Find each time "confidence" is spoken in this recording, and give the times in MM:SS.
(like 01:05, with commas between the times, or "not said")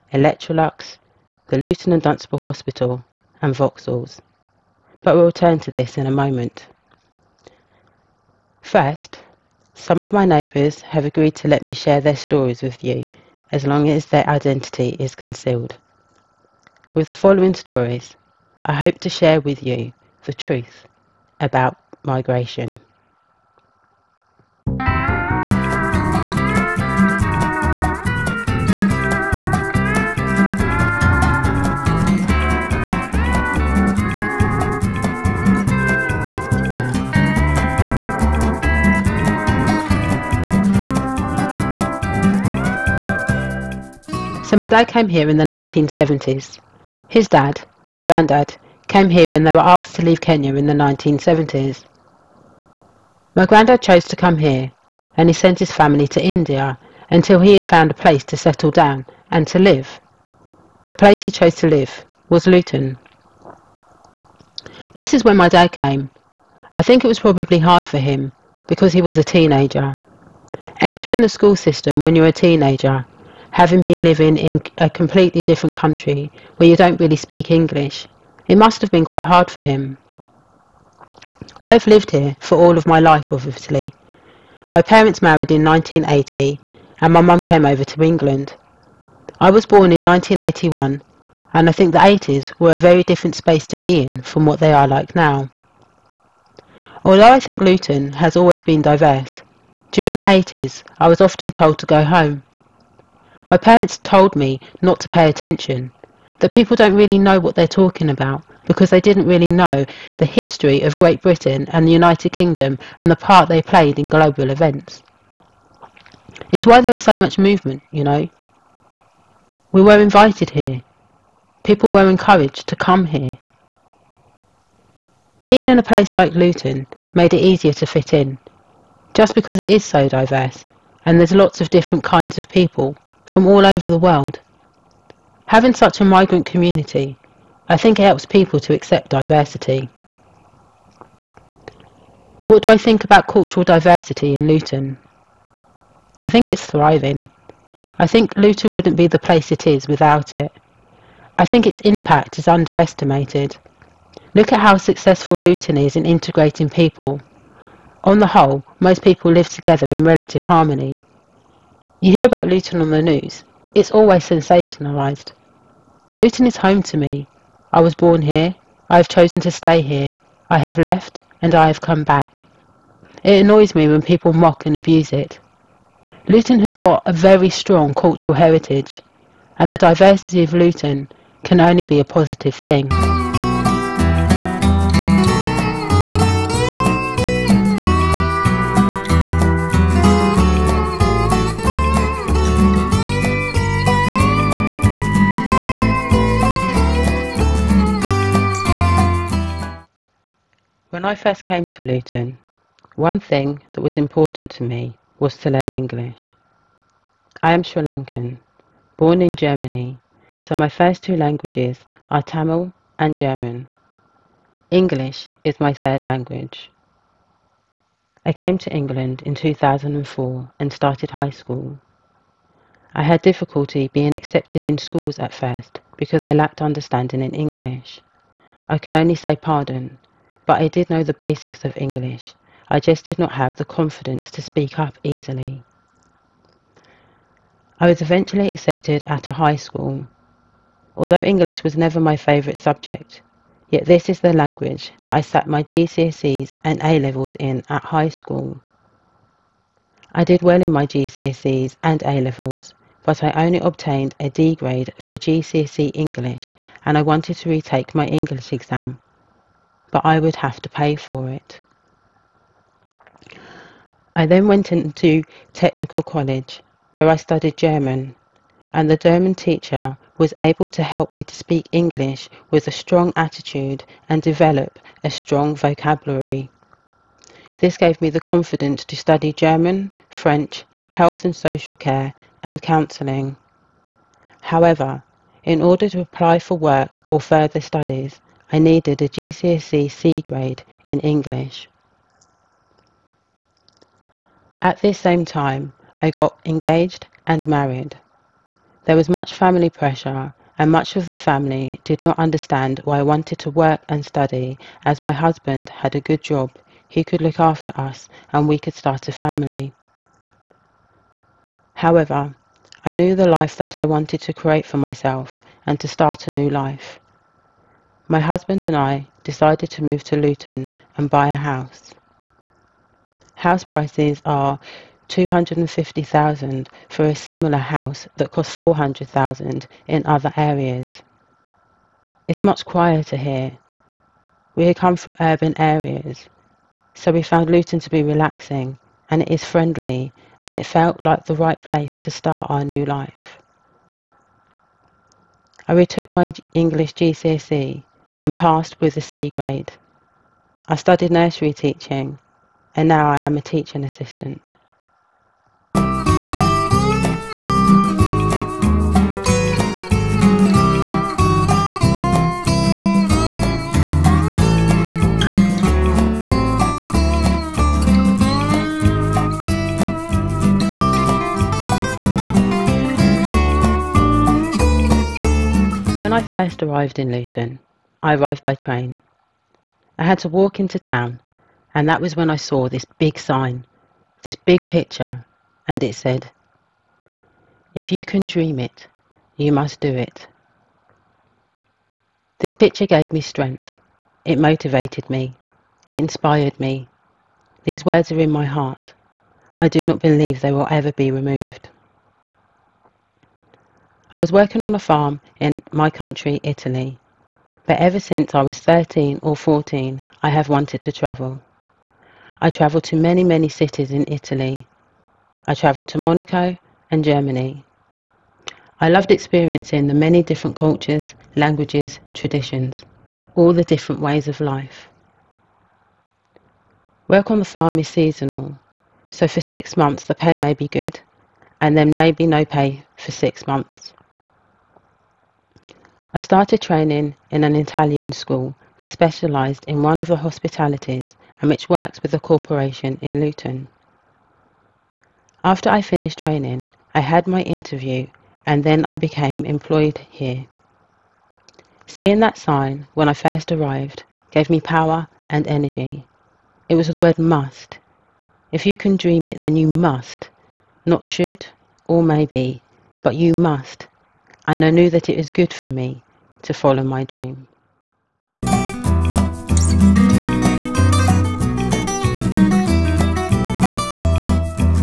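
03:53, 04:38.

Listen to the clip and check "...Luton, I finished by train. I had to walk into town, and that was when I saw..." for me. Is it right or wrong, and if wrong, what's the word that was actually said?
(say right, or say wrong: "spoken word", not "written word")
wrong: "arrived", not "finished".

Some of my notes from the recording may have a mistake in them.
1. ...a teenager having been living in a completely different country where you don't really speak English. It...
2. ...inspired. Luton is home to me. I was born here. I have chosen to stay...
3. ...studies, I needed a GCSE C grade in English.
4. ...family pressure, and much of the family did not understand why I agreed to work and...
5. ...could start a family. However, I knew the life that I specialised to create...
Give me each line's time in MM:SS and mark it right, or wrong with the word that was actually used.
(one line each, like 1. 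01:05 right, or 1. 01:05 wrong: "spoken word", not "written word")
1. 01:12 right
2. 02:44 wrong: "sensationalised", not "inspired"
3. 04:47 right
4. 04:59 wrong: "wanted", not "agreed"
5. 05:08 wrong: "wanted", not "specialised".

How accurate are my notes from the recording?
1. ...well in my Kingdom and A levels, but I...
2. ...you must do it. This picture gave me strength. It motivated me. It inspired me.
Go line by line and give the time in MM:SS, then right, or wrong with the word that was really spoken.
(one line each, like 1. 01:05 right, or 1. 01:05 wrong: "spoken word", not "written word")
1. 04:10 wrong: "GCSEs", not "Kingdom"
2. 06:29 right.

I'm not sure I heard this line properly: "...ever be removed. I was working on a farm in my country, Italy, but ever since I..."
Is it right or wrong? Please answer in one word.
right.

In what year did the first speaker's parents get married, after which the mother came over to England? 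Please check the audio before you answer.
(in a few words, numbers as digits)
1980.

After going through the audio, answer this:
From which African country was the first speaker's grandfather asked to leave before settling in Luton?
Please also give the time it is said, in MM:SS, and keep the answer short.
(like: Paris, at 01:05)
Kenya, at 00:50.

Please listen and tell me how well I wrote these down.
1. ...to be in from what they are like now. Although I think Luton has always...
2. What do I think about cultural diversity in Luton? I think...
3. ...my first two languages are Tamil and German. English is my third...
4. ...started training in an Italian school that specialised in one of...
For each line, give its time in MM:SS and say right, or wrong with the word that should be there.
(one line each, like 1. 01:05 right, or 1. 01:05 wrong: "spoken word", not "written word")
1. 01:33 right
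2. 02:22 right
3. 03:30 right
4. 07:16 right.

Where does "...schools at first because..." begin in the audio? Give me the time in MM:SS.
03:44.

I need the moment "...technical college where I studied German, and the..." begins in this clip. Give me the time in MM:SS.
04:25.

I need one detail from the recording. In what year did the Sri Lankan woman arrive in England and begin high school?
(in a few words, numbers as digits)
2004.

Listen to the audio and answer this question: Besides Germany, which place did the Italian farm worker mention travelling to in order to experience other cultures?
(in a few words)
Monaco.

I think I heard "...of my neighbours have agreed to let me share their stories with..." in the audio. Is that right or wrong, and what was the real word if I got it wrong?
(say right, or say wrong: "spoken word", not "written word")
right.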